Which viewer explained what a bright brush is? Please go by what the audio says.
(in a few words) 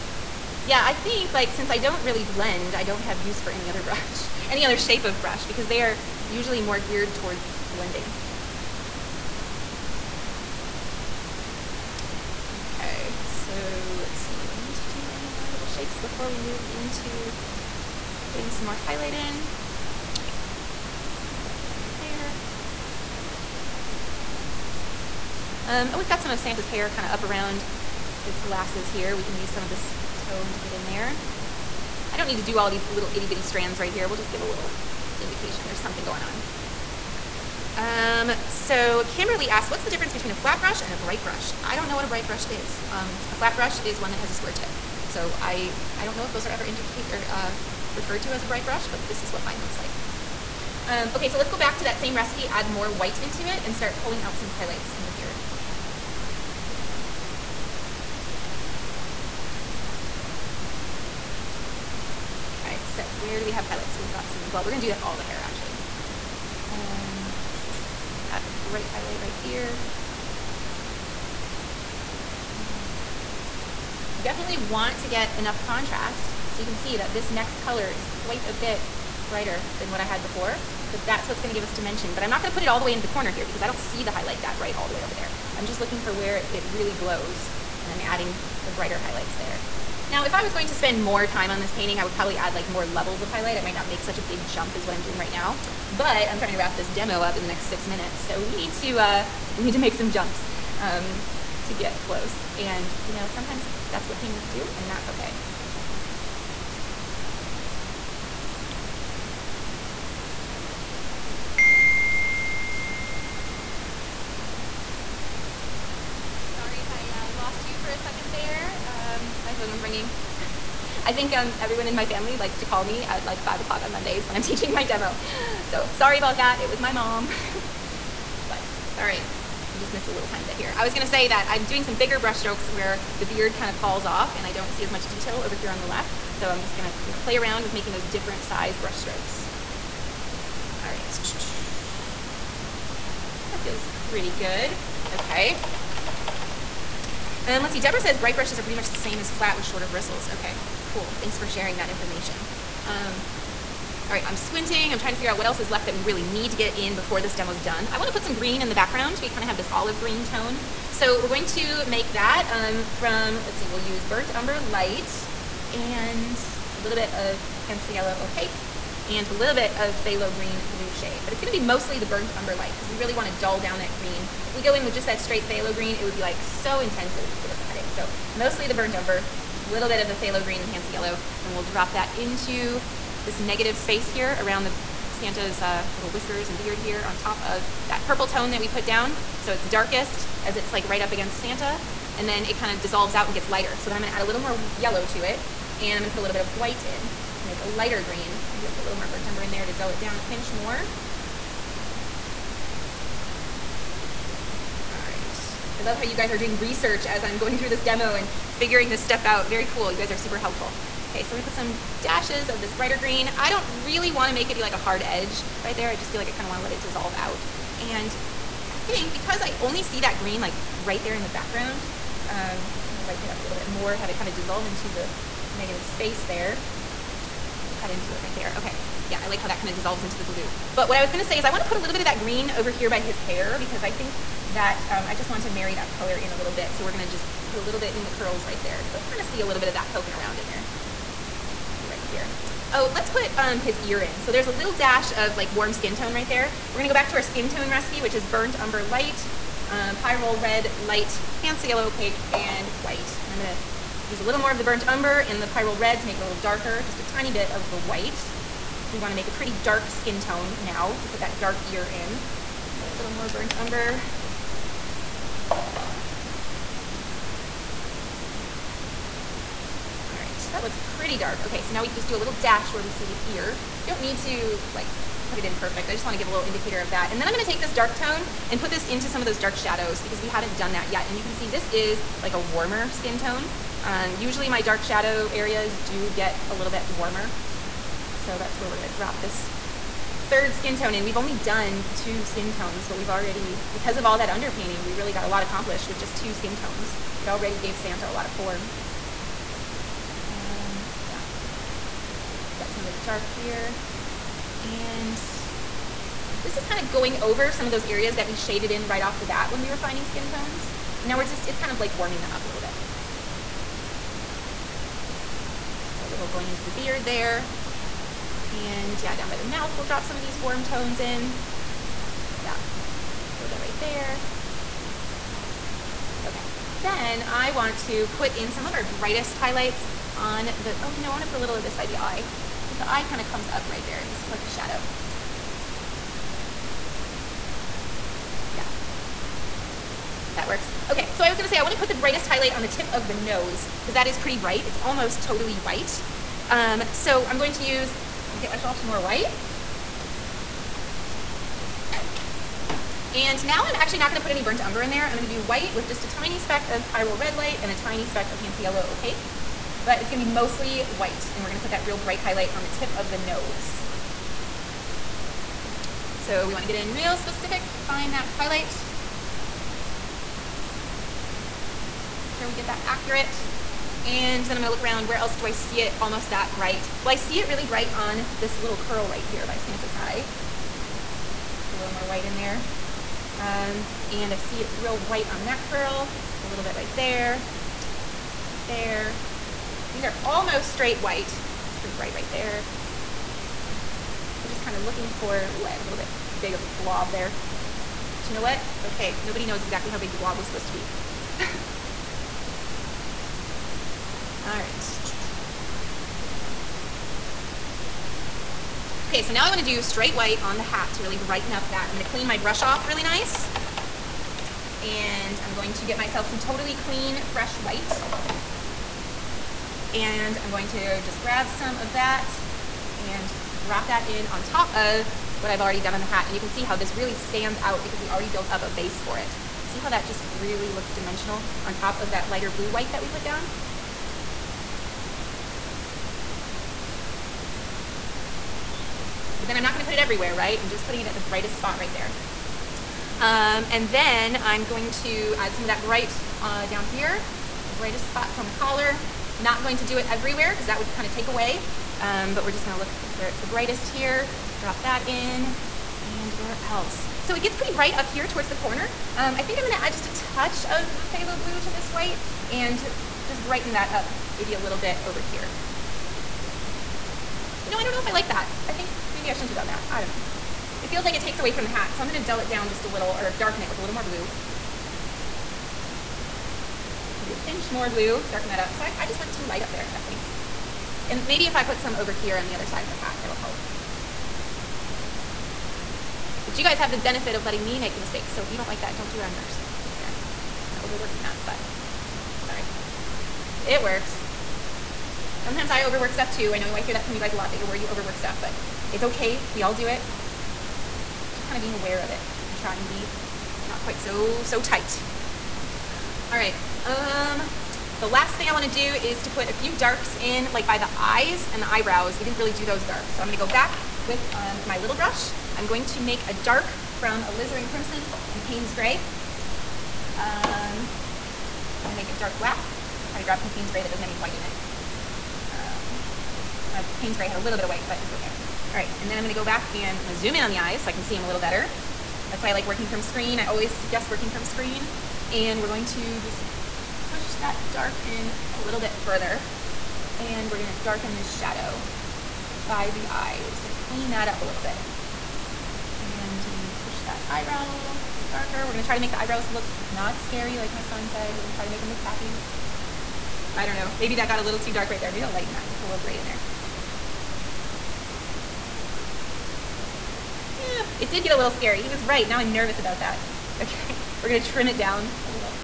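Deborah.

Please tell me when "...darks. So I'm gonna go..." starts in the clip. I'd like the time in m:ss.
8:32.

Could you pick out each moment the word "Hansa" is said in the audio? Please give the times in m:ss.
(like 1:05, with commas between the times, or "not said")
2:47, 3:00, 4:11, 5:58.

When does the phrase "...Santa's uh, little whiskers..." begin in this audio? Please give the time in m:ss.
3:05.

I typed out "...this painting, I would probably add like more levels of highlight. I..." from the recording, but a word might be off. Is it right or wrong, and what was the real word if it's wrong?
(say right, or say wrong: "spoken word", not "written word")
right.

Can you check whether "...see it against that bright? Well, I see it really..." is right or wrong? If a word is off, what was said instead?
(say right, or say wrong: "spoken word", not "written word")
wrong: "almost", not "against".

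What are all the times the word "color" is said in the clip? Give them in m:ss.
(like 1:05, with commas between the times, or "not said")
1:17, 3:55.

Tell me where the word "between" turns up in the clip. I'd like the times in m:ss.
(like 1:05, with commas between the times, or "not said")
0:40.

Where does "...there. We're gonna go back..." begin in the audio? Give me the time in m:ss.
4:06.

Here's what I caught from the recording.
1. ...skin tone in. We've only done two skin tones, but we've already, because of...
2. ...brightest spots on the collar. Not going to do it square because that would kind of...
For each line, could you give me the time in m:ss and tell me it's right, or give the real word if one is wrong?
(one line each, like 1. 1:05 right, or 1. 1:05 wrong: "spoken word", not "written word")
1. 4:50 right
2. 7:27 wrong: "everywhere", not "square".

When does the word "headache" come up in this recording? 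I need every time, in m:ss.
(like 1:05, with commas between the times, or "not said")
2:57.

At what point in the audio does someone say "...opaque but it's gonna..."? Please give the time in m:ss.
5:58.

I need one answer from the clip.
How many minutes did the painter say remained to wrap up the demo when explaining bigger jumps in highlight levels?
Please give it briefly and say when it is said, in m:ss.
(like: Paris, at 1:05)
6, at 1:37.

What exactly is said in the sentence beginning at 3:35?
I just feel like I kinda wanna let it dissolve out.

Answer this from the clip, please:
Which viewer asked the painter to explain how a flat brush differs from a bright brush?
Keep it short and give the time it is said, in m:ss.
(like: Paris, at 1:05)
Kimberly, at 0:39.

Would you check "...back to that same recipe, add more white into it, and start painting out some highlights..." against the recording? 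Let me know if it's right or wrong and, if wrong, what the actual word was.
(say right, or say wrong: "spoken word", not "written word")
wrong: "pulling", not "painting".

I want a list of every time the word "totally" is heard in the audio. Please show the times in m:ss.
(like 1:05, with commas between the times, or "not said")
5:45, 6:56.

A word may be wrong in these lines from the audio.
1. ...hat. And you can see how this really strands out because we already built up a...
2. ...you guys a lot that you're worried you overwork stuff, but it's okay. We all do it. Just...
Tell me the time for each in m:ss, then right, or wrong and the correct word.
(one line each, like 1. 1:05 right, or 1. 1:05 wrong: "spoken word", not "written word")
1. 7:06 wrong: "stands", not "strands"
2. 8:17 right.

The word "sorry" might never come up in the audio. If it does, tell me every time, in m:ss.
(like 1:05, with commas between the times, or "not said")
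1:56, 2:05.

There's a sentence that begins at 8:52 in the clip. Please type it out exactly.
That's why I like working from a screen.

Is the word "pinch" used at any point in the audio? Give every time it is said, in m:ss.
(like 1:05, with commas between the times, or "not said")
3:20, 7:57.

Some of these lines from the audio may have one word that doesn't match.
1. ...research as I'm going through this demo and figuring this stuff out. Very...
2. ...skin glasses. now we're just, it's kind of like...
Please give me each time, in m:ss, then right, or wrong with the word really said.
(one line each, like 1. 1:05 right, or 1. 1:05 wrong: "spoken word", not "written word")
1. 3:26 right
2. 5:10 wrong: "tones", not "glasses".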